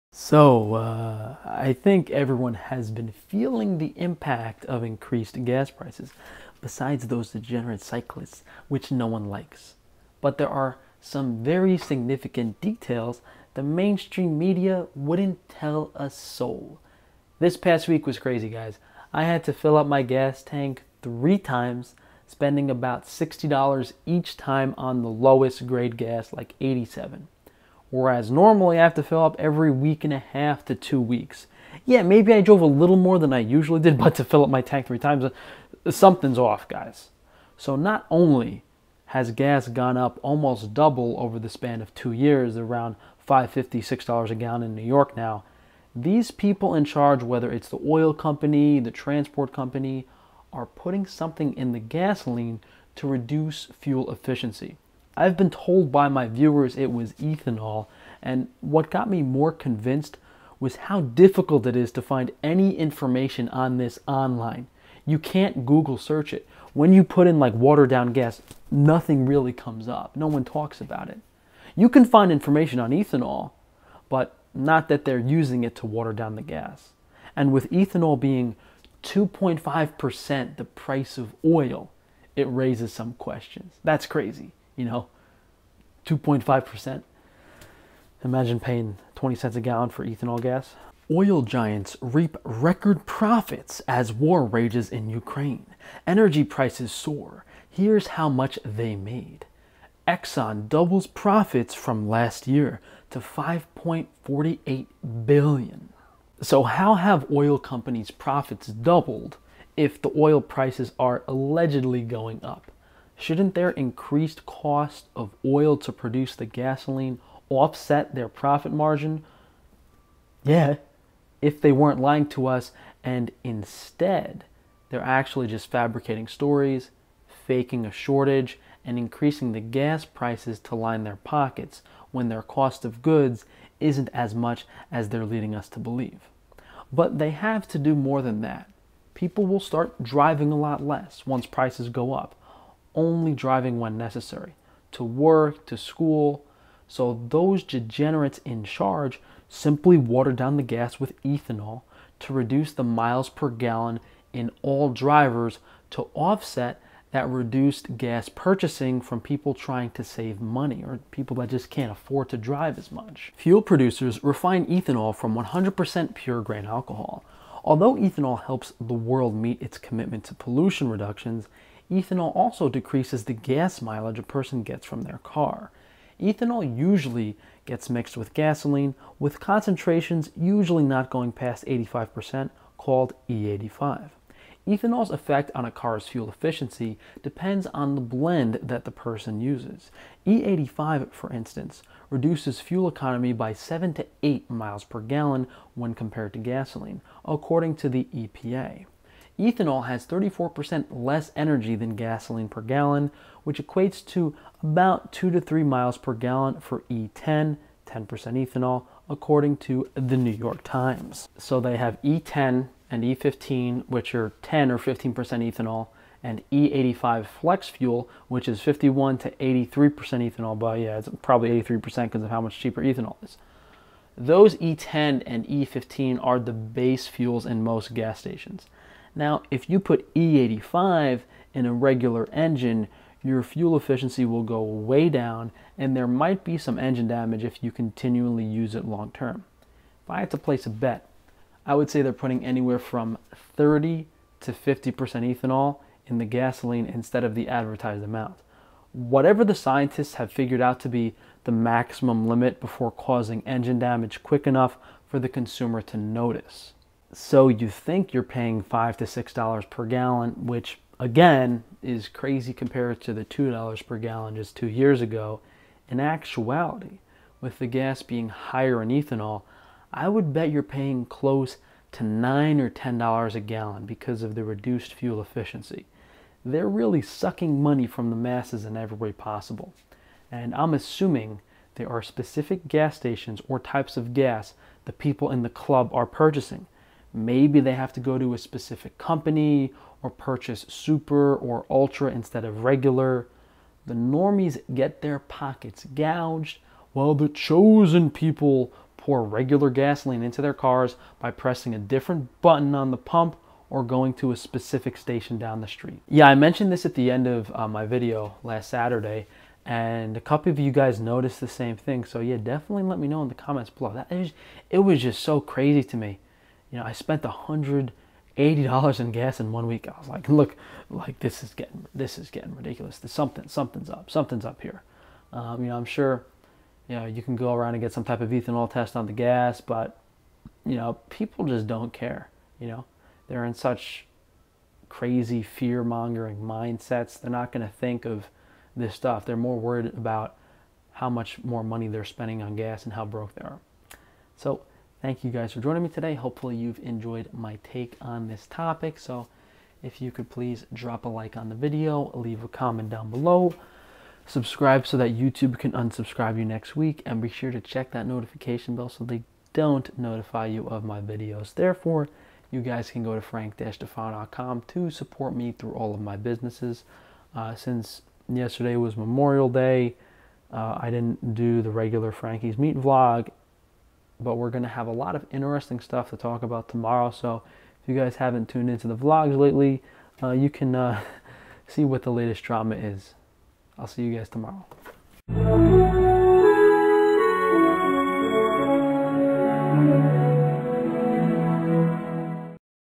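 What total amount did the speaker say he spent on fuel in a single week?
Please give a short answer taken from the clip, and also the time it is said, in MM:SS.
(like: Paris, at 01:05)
$180, at 05:17.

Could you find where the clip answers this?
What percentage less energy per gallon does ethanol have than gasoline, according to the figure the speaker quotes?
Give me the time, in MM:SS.
03:20.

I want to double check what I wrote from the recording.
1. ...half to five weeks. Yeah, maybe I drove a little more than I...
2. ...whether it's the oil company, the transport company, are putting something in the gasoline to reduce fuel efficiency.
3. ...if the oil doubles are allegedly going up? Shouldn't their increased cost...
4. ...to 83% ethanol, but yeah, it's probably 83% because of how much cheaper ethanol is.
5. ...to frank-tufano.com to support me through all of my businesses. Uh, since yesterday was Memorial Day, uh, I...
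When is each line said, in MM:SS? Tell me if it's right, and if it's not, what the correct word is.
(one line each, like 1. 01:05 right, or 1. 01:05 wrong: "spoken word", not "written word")
1. 00:30 wrong: "two", not "five"
2. 00:47 right
3. 01:49 wrong: "prices", not "doubles"
4. 03:39 right
5. 06:03 right.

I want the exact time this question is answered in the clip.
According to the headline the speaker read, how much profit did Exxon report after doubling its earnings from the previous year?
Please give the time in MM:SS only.
01:43.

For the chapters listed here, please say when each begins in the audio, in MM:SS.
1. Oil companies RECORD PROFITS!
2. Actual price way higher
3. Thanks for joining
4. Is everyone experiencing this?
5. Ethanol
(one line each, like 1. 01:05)
1. 01:30
2. 04:16
3. 05:44
4. 05:05
5. 02:43.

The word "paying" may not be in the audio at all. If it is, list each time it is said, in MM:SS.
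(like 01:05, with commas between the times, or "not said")
01:28, 04:18, 04:30.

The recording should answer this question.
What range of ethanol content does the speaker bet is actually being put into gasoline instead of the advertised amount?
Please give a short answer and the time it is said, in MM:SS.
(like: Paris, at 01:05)
30 to 50%, at 04:03.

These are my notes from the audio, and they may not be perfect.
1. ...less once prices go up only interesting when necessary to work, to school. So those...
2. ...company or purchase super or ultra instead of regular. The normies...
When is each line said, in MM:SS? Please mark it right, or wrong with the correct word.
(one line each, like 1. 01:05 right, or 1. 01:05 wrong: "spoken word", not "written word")
1. 02:20 wrong: "driving", not "interesting"
2. 04:48 right.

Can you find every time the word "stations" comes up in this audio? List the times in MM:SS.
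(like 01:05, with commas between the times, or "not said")
03:48, 04:42, 05:04.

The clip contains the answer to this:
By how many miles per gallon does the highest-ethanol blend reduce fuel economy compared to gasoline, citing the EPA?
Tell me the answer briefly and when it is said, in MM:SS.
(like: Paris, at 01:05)
7 to 8, at 03:13.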